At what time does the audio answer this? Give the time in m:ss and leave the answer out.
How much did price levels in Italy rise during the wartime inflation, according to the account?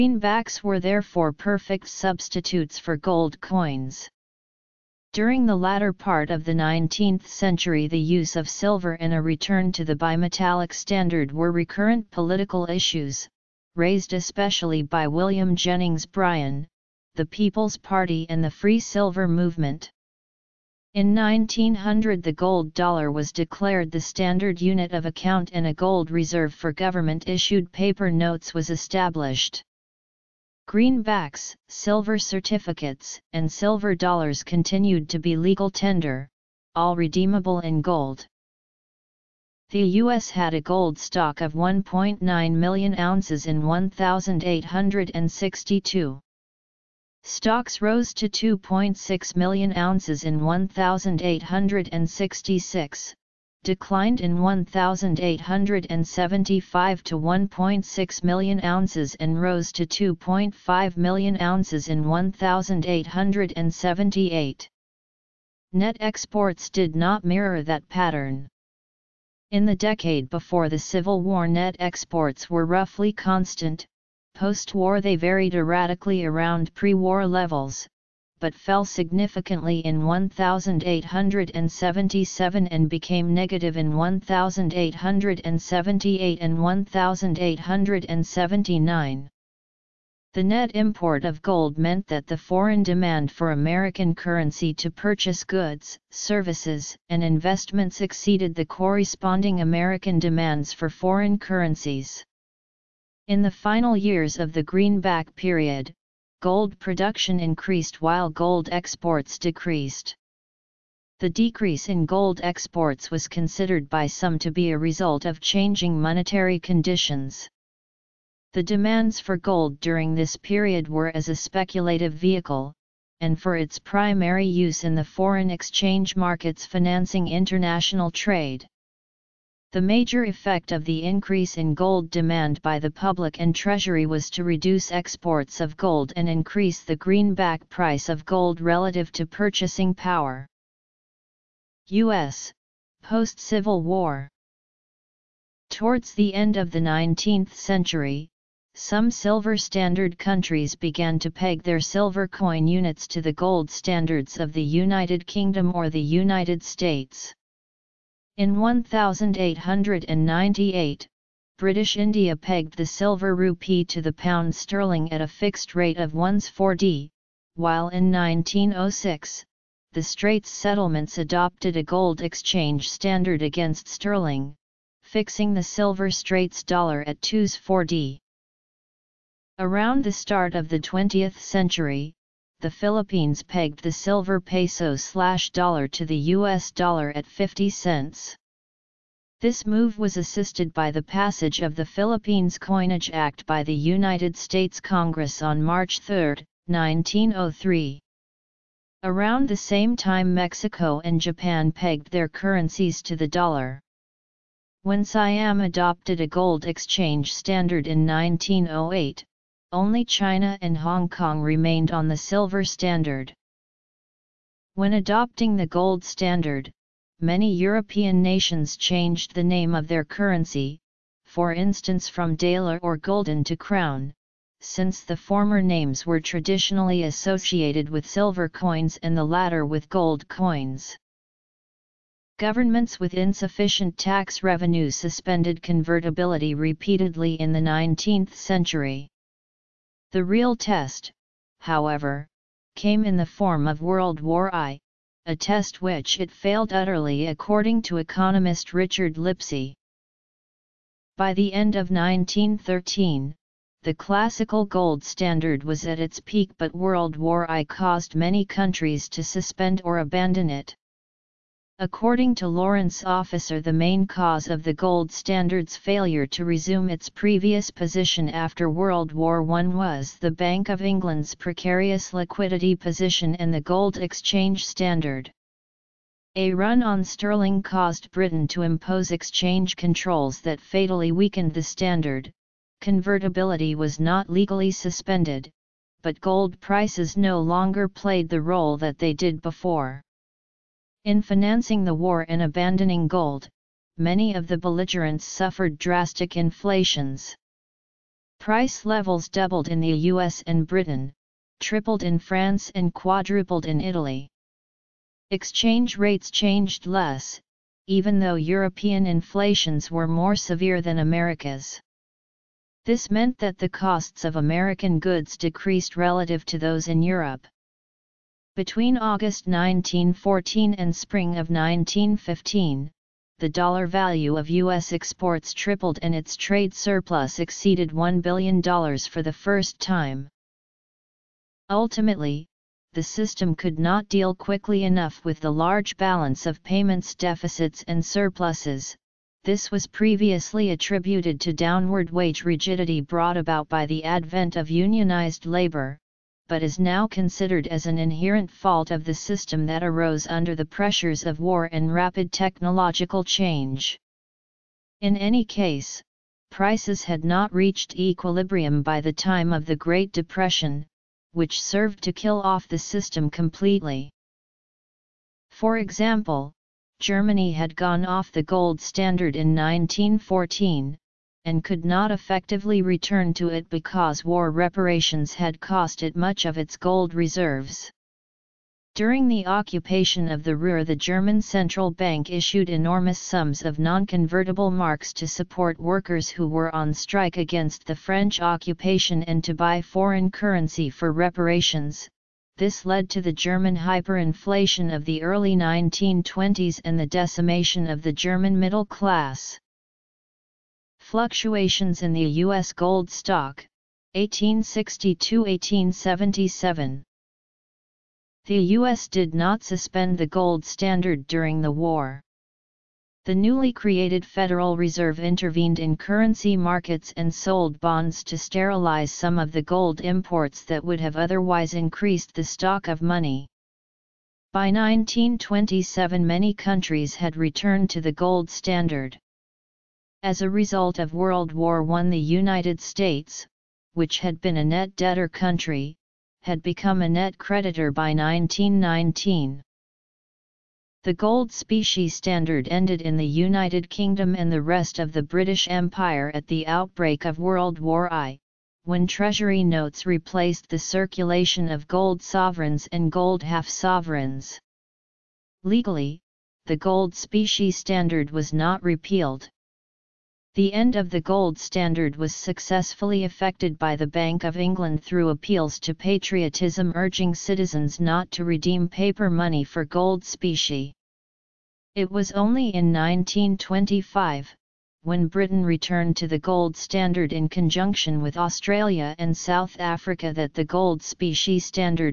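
5:02.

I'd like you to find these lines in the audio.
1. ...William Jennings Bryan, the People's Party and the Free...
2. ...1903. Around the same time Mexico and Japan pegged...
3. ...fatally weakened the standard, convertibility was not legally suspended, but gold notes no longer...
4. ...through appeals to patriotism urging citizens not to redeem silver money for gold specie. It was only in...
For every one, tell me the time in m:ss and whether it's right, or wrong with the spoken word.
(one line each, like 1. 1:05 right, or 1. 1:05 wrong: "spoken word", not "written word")
1. 0:15 right
2. 3:16 right
3. 4:40 wrong: "prices", not "notes"
4. 7:45 wrong: "paper", not "silver".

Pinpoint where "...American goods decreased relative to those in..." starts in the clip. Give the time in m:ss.
5:14.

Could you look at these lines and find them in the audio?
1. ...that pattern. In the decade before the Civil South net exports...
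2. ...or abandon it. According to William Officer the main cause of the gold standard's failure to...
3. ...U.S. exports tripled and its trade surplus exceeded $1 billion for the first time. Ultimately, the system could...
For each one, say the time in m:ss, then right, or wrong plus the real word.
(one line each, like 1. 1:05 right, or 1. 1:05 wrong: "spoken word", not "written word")
1. 1:07 wrong: "War", not "South"
2. 4:19 wrong: "Lawrence", not "William"
3. 5:24 right.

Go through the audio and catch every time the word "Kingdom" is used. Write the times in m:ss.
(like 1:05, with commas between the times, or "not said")
2:35, 7:23.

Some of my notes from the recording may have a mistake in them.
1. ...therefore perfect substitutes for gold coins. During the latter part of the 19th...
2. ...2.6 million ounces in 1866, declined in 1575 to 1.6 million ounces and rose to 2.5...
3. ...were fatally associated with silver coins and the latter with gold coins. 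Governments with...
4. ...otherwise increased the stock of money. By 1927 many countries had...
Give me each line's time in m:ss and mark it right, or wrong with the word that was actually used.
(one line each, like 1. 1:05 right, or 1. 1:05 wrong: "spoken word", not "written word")
1. 0:00 right
2. 0:48 wrong: "1875", not "1575"
3. 3:46 wrong: "traditionally", not "fatally"
4. 7:01 right.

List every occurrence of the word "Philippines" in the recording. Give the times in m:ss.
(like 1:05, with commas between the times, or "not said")
3:02, 3:11.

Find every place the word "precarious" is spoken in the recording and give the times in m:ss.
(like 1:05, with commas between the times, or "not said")
4:31.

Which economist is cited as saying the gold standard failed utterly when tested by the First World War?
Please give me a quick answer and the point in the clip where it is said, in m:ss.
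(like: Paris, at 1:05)
Richard Lipsey, at 4:08.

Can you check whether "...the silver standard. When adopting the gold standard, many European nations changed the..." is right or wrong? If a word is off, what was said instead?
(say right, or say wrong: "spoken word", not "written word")
right.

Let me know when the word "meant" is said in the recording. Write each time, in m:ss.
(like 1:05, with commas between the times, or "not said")
1:31, 5:13.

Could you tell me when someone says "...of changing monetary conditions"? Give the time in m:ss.
1:55.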